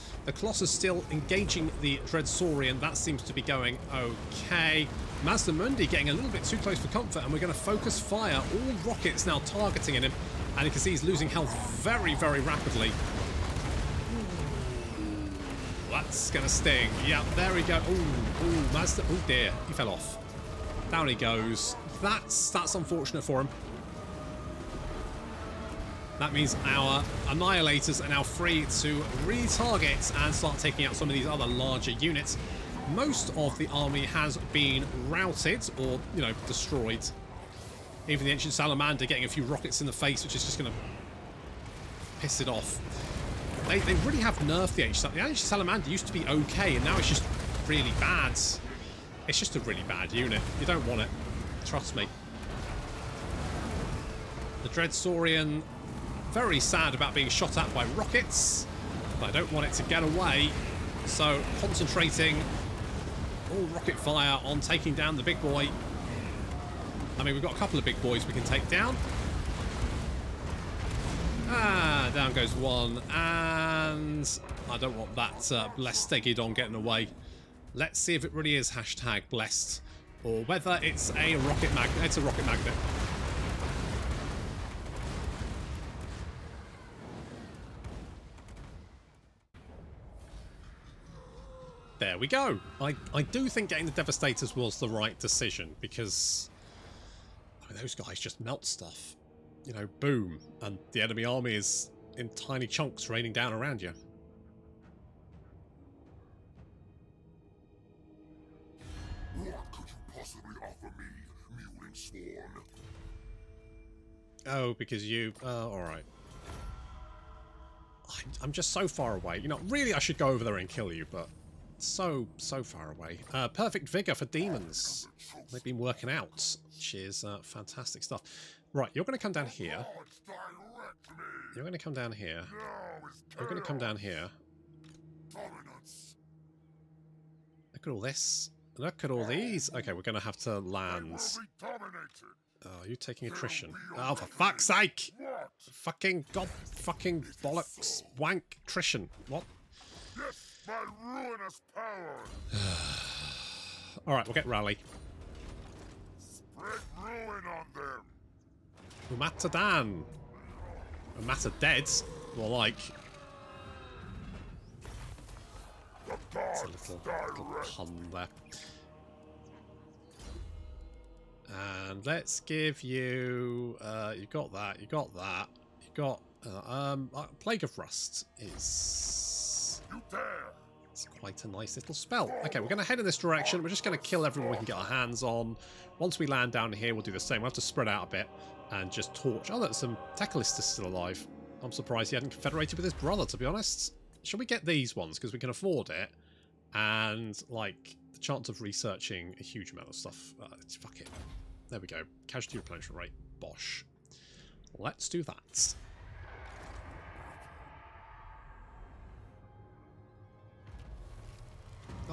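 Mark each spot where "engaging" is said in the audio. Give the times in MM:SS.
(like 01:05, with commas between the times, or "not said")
00:01.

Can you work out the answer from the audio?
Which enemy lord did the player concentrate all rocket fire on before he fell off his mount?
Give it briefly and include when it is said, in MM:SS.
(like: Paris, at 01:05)
Mazdamundi, at 00:05.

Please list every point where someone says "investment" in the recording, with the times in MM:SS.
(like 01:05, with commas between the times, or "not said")
not said.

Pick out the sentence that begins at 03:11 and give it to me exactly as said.
I'm surprised he hadn't confederated with his brother, to be honest.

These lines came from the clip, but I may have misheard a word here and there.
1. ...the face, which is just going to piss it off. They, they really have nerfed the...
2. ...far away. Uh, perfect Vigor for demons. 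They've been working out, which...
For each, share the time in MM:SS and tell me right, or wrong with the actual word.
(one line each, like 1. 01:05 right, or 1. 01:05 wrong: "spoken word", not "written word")
1. 00:39 right
2. 02:02 right.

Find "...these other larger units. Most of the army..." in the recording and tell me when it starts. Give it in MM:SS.
00:31.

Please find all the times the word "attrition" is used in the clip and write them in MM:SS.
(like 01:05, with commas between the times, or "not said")
02:23, 02:28.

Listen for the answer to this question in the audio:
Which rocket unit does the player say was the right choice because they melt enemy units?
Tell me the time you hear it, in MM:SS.
01:33.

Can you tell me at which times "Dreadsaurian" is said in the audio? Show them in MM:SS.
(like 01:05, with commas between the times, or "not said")
00:02, 00:54.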